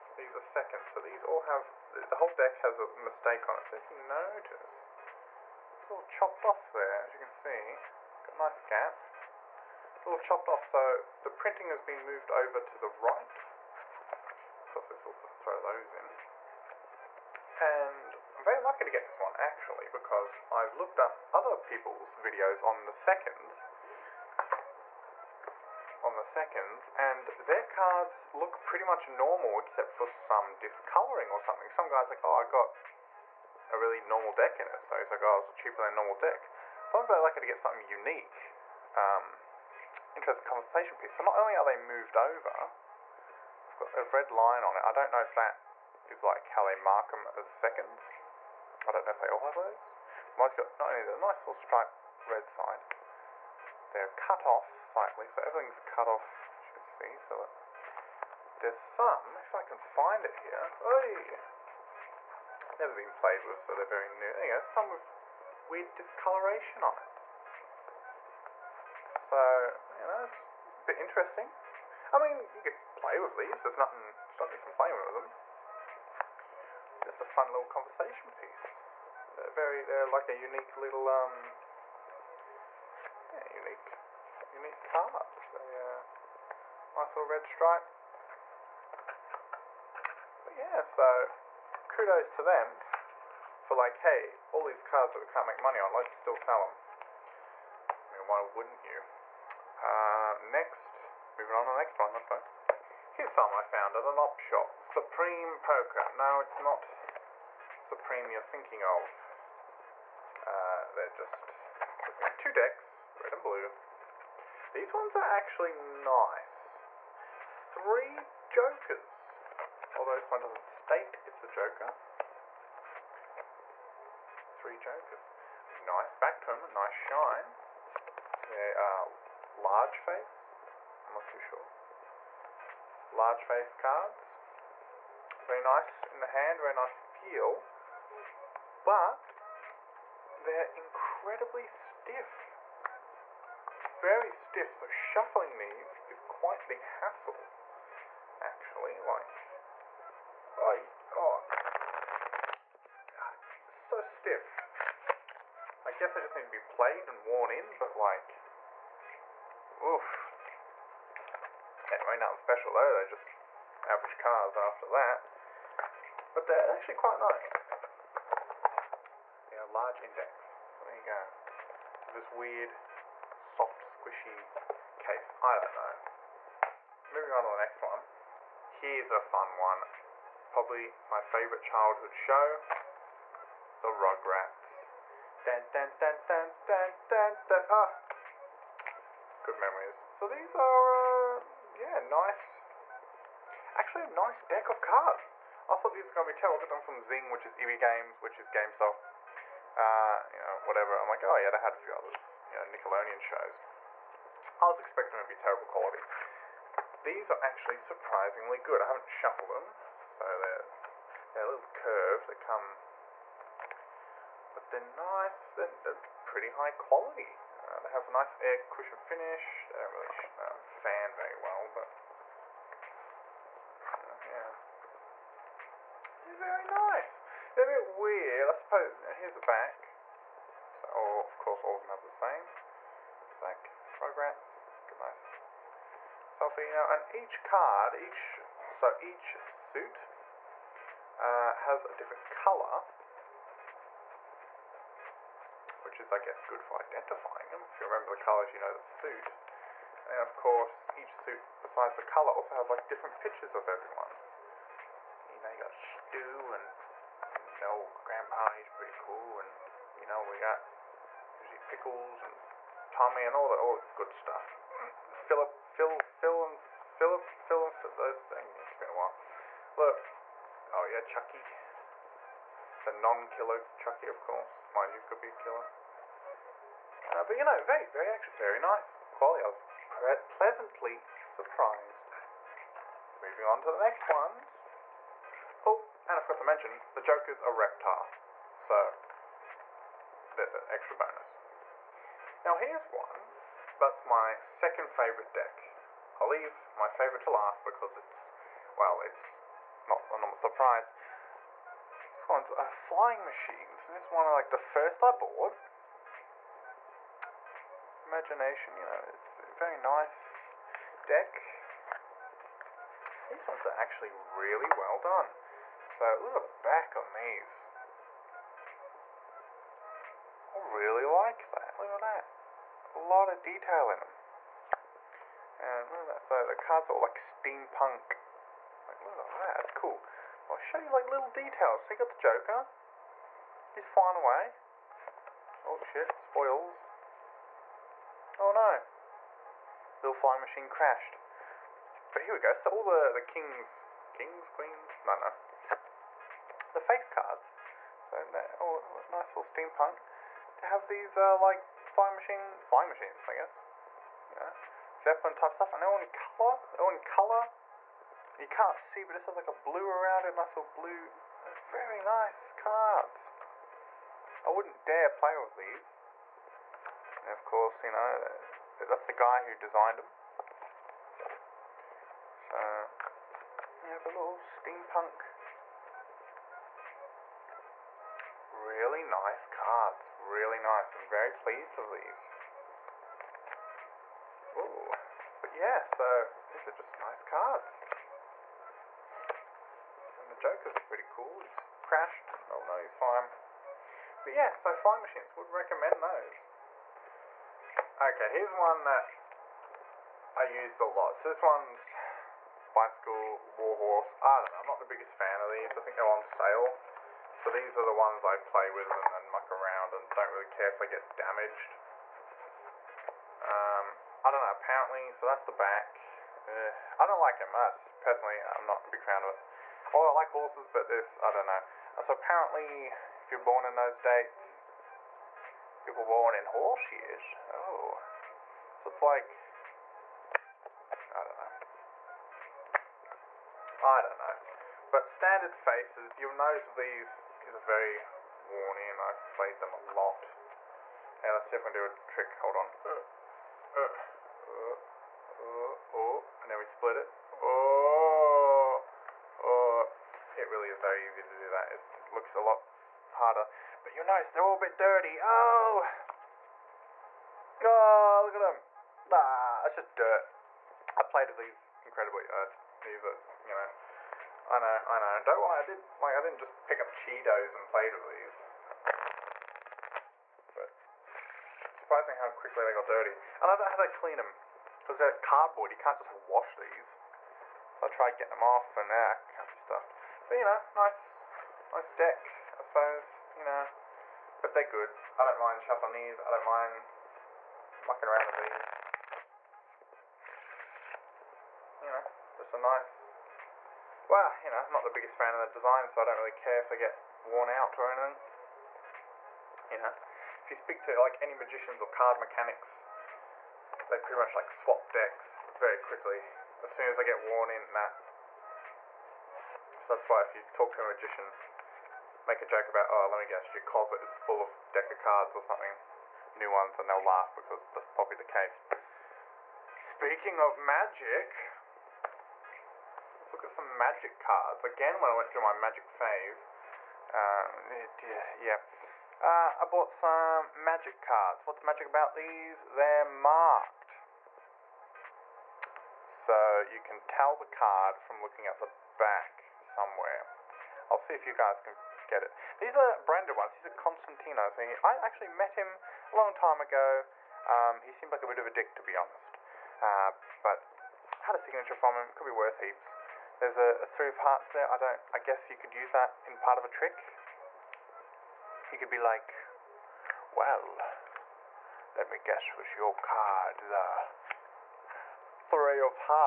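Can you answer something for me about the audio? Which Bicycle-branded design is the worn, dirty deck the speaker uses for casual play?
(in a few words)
Warhorse.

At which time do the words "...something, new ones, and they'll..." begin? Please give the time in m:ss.
8:35.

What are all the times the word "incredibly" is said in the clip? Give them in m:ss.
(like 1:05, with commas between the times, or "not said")
2:20, 7:41.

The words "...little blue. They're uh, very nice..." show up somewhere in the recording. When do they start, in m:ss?
6:00.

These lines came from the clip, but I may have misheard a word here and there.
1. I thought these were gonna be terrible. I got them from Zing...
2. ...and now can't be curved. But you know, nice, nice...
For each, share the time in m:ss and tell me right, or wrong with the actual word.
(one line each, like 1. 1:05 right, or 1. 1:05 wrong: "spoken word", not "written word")
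1. 3:15 right
2. 7:58 wrong: "stuffed", not "curved".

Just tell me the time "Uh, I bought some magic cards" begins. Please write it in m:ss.
8:49.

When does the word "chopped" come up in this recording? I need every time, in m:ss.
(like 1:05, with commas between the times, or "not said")
0:06, 0:10.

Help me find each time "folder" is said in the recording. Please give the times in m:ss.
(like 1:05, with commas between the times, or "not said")
not said.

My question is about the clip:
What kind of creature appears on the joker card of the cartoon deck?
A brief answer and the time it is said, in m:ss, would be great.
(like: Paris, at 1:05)
A reptile, at 4:46.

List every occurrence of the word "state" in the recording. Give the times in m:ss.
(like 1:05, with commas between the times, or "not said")
2:00.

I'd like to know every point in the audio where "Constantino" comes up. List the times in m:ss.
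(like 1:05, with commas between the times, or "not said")
9:03.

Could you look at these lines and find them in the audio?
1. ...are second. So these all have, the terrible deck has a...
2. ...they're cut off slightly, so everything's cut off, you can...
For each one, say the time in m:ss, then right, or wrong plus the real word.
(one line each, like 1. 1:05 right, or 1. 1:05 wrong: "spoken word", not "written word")
1. 0:00 wrong: "whole", not "terrible"
2. 0:53 right.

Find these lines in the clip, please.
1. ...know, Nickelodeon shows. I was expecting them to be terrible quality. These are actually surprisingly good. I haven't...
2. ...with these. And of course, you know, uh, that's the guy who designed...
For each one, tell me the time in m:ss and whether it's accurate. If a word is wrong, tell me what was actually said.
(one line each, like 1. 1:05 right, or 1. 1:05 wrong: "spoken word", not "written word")
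1. 3:22 right
2. 6:05 right.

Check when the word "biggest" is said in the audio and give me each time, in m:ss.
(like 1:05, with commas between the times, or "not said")
6:44, 8:14.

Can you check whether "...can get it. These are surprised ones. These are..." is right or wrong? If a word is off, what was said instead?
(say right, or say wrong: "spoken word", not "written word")
wrong: "branded", not "surprised".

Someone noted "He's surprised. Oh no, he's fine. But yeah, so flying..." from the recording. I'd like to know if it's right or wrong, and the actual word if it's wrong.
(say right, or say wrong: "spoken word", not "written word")
wrong: "crashed", not "surprised".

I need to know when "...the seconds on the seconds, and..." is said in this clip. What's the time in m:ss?
0:22.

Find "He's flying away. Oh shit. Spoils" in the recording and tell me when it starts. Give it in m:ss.
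5:33.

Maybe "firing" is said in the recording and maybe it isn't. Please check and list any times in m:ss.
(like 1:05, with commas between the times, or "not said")
not said.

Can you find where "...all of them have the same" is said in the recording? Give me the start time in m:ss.
3:51.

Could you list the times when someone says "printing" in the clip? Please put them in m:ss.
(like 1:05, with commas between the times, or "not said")
0:11.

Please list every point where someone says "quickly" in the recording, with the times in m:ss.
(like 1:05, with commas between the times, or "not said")
7:52, 8:25.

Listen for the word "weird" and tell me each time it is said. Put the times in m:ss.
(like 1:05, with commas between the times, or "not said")
1:05, 2:52, 3:47.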